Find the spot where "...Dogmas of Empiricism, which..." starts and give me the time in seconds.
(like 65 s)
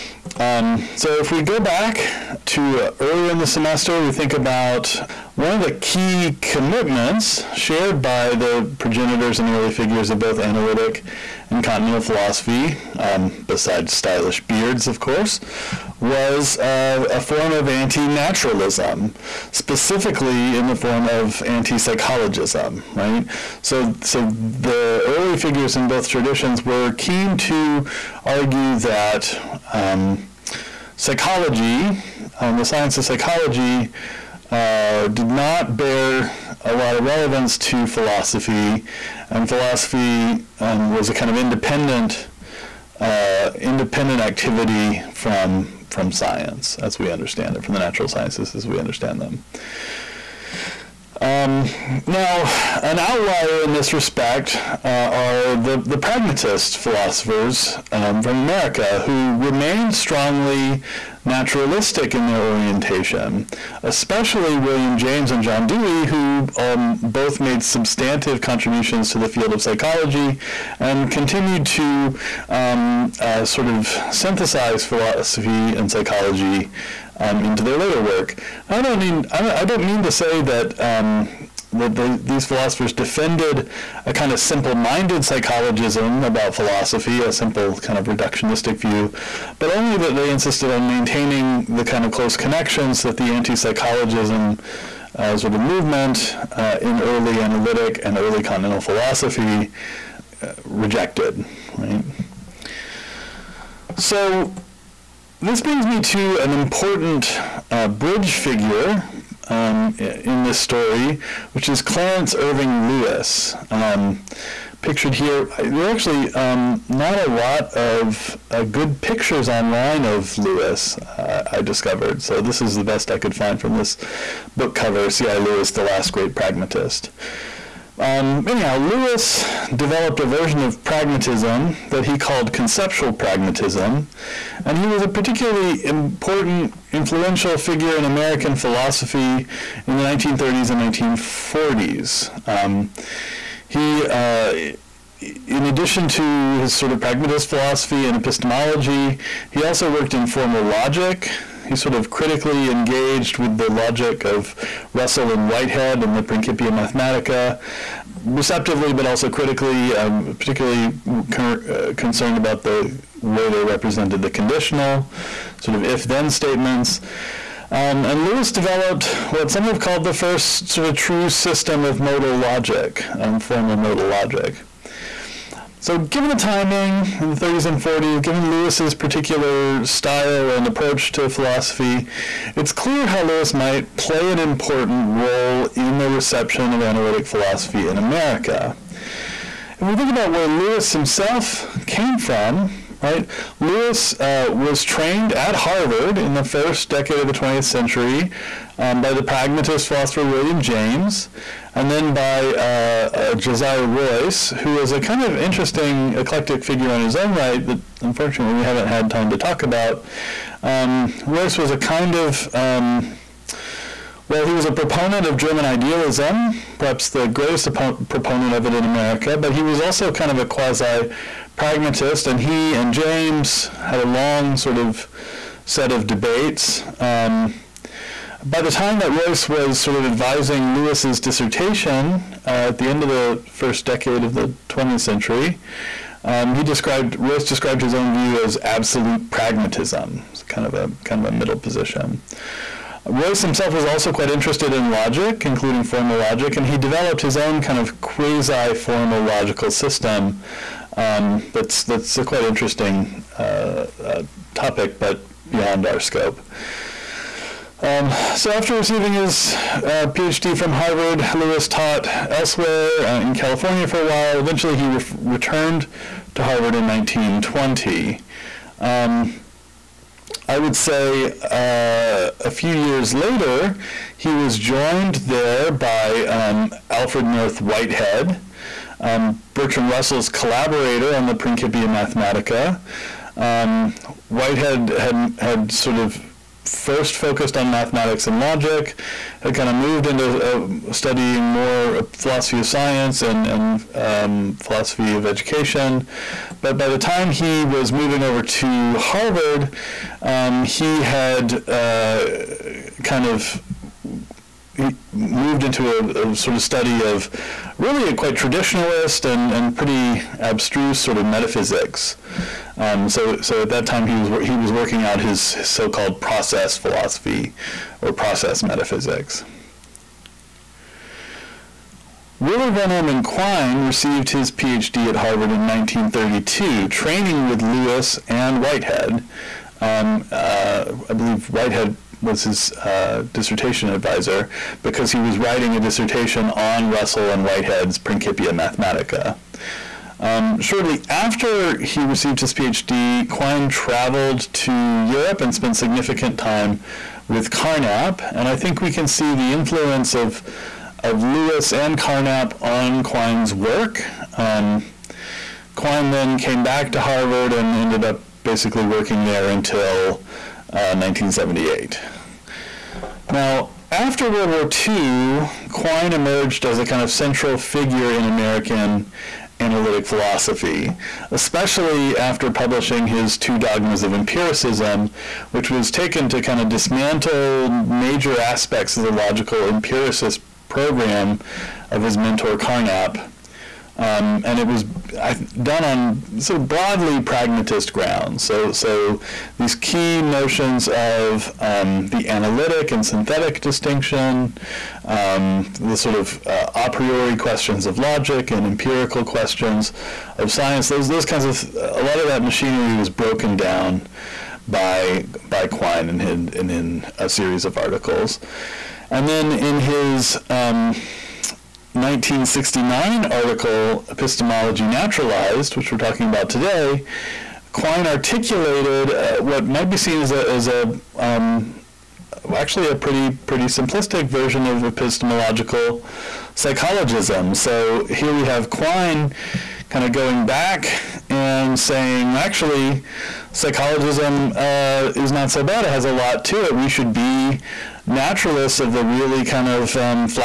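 373 s.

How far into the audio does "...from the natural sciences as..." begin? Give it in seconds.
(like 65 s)
47 s.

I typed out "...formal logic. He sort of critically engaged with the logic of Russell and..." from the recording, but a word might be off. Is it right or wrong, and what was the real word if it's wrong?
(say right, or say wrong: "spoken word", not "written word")
right.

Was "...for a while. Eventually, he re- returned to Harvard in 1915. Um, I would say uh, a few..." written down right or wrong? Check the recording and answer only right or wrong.
wrong.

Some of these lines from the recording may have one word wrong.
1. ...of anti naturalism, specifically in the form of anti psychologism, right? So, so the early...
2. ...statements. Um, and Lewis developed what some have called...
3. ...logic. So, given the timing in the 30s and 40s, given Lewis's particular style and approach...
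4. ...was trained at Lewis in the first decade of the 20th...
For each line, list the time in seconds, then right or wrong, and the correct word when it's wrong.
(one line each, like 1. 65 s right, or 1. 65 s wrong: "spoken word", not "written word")
1. 17 s right
2. 166 s right
3. 174 s right
4. 194 s wrong: "Harvard", not "Lewis".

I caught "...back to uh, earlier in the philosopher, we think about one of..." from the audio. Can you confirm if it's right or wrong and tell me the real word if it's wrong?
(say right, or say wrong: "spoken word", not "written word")
wrong: "semester", not "philosopher".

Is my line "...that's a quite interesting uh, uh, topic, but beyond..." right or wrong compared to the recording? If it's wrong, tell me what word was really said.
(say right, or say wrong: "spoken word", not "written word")
right.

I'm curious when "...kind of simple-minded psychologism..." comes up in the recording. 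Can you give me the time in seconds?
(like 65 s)
84 s.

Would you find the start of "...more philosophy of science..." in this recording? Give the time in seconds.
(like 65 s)
291 s.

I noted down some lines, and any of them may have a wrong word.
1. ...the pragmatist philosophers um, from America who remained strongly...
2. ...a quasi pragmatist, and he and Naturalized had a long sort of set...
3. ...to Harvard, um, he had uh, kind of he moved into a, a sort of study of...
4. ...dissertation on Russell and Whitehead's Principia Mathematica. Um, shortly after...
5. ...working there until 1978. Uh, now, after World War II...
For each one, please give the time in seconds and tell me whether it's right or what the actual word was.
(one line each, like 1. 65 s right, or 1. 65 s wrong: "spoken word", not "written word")
1. 55 s right
2. 220 s wrong: "James", not "Naturalized"
3. 298 s right
4. 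335 s right
5. 358 s right.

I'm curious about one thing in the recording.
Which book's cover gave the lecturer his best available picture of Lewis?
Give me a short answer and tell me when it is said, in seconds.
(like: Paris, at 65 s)
C.I. Lewis, The Last Great Pragmatist, at 125 s.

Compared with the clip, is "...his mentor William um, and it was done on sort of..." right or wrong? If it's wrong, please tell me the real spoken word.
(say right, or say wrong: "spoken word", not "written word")
wrong: "Carnap", not "William".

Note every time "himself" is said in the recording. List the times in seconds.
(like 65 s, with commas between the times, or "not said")
190 s, 243 s.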